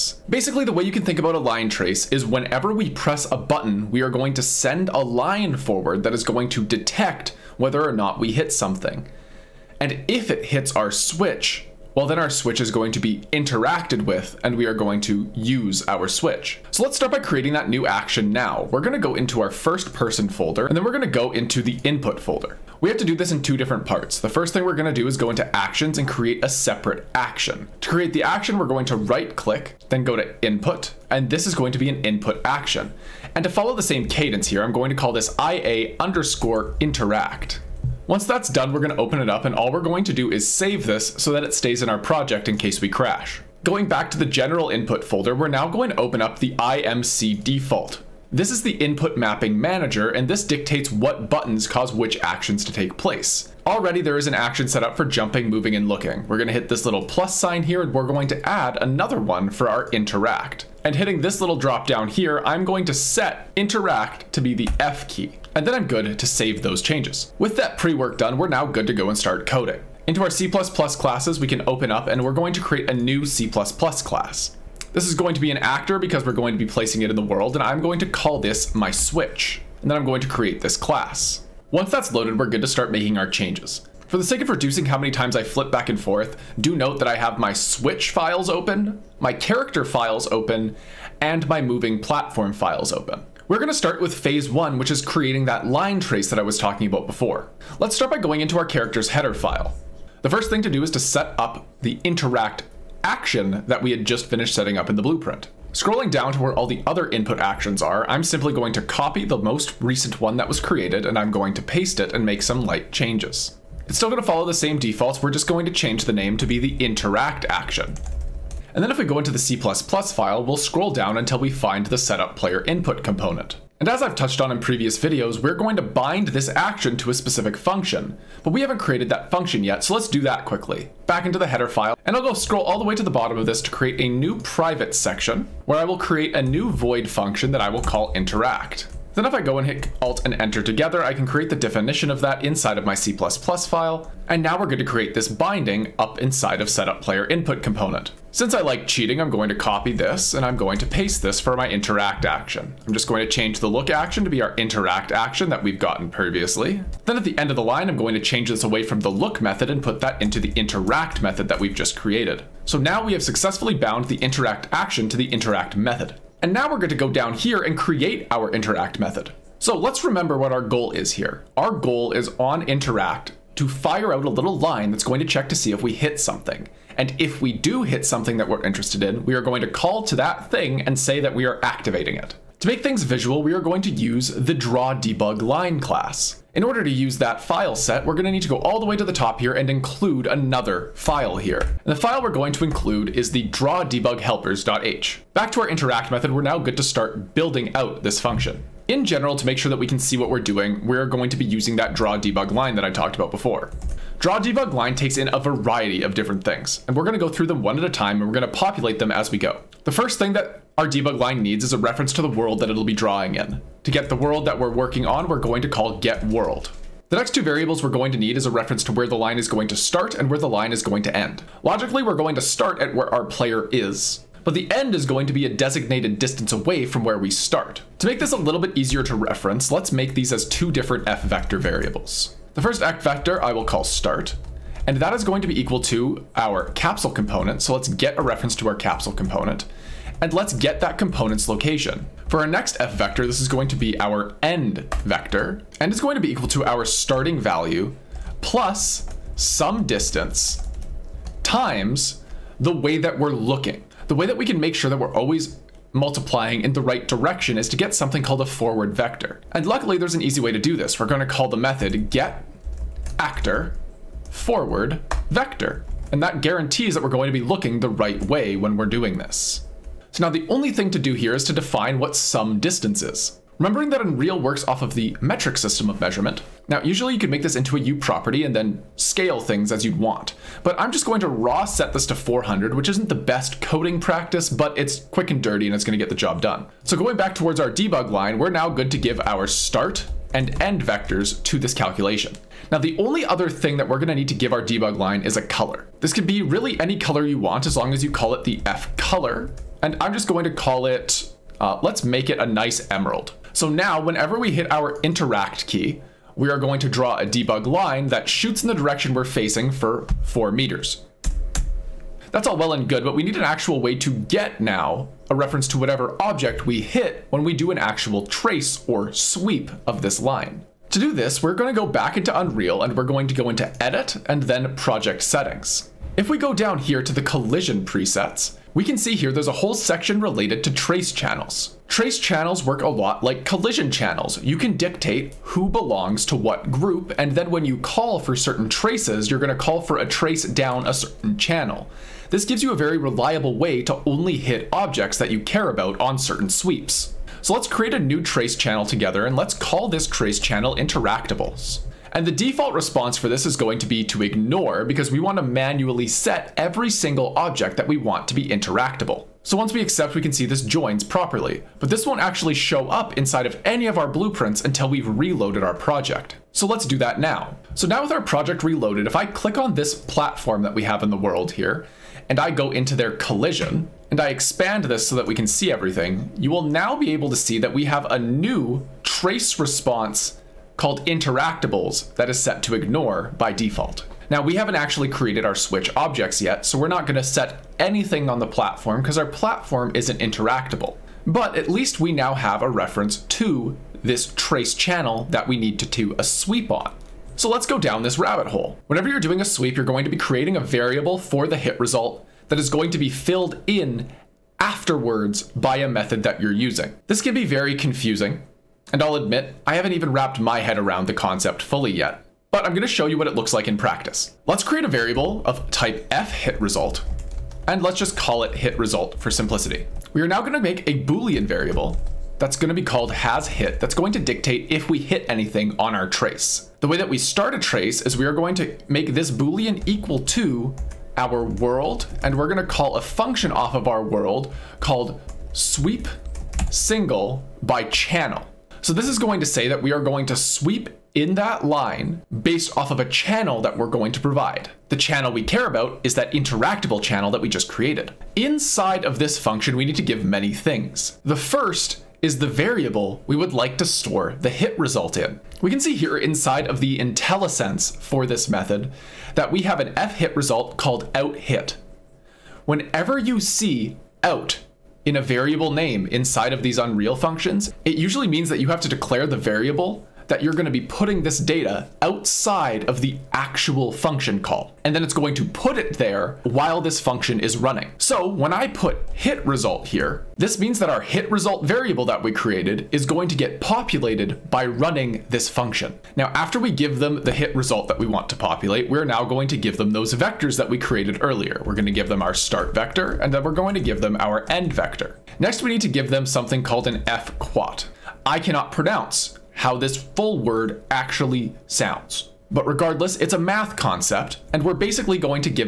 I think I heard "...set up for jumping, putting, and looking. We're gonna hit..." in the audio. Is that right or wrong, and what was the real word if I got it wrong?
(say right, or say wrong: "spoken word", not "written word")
wrong: "moving", not "putting".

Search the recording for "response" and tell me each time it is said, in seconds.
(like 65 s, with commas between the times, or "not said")
352 s, 379 s.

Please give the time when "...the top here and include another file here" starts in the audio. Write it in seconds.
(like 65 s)
189 s.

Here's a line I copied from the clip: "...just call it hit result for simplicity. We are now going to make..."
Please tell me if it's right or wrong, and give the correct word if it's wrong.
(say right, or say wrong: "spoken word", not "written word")
right.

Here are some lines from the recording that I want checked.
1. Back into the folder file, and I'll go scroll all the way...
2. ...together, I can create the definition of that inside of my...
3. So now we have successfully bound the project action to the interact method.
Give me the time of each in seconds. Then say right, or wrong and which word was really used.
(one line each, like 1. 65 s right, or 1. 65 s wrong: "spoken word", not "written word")
1. 131 s wrong: "header", not "folder"
2. 140 s right
3. 162 s wrong: "interact", not "project".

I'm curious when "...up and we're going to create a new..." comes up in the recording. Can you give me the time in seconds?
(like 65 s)
71 s.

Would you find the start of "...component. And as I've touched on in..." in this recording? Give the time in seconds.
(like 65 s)
123 s.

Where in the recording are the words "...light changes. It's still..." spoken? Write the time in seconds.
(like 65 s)
112 s.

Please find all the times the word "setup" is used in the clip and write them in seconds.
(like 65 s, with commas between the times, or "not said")
121 s, 146 s.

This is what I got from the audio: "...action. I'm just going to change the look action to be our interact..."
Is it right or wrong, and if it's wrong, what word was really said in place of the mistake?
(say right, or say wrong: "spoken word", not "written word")
right.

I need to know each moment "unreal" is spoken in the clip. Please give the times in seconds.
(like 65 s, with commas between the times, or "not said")
274 s, 322 s, 466 s.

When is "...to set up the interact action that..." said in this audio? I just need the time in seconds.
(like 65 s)
100 s.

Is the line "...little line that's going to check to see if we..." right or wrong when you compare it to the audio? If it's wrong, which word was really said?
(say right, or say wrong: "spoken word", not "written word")
right.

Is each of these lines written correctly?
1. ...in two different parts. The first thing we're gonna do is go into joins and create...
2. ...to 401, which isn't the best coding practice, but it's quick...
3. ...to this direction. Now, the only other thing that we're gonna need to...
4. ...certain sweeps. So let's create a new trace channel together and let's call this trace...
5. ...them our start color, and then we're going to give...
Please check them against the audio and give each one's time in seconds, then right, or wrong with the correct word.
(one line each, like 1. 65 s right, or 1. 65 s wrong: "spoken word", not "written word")
1. 23 s wrong: "actions", not "joins"
2. 282 s wrong: "400", not "401"
3. 291 s wrong: "calculation", not "direction"
4. 346 s right
5. 492 s wrong: "vector", not "color".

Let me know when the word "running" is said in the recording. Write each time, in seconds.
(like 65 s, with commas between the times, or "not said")
477 s, 484 s.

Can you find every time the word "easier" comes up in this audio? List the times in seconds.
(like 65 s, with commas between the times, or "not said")
228 s.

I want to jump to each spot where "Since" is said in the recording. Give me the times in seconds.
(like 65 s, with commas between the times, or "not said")
148 s.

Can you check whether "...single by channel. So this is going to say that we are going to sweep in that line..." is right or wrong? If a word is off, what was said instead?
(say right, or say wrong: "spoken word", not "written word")
right.